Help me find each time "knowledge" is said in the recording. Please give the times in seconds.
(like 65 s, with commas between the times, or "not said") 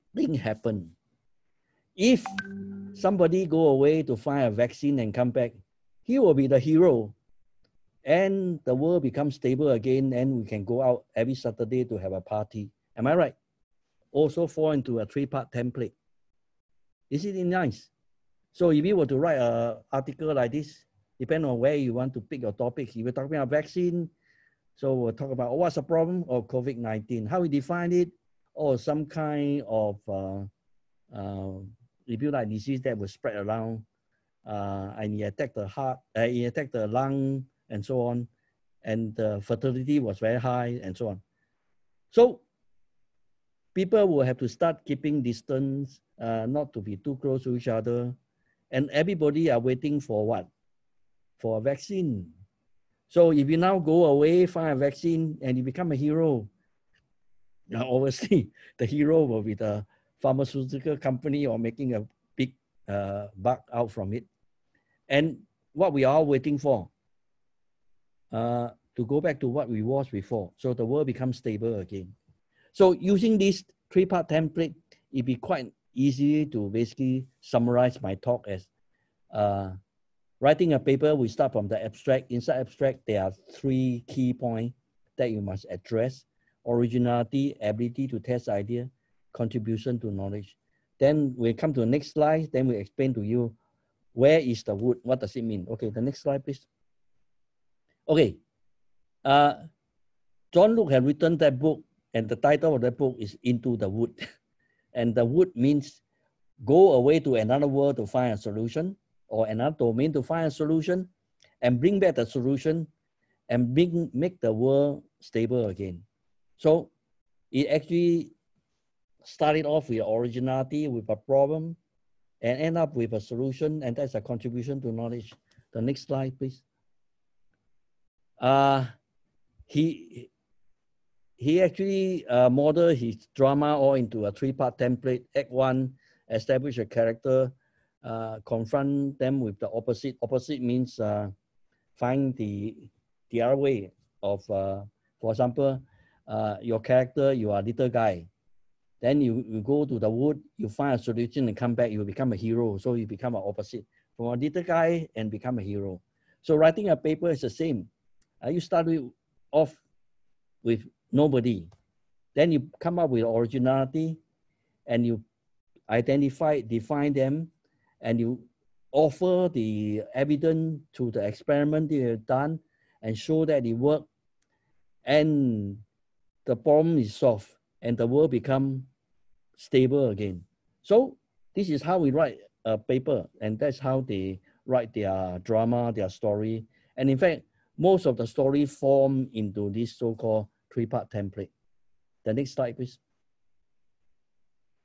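90 s, 124 s.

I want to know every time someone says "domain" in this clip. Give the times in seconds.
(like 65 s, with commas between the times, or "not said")
109 s.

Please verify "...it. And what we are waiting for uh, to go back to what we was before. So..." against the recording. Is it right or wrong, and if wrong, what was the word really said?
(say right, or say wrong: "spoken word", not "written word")
right.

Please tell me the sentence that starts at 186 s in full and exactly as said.
And in fact, most of the story form into this so-called three-part template.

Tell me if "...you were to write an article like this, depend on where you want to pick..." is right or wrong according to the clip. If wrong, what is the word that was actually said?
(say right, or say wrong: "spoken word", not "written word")
right.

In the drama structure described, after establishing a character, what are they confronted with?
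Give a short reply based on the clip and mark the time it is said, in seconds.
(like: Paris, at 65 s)
the opposite, at 139 s.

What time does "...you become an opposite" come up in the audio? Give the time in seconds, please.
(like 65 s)
152 s.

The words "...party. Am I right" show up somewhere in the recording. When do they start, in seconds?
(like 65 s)
12 s.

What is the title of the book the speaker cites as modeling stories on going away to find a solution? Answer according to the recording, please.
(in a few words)
Into the Wood.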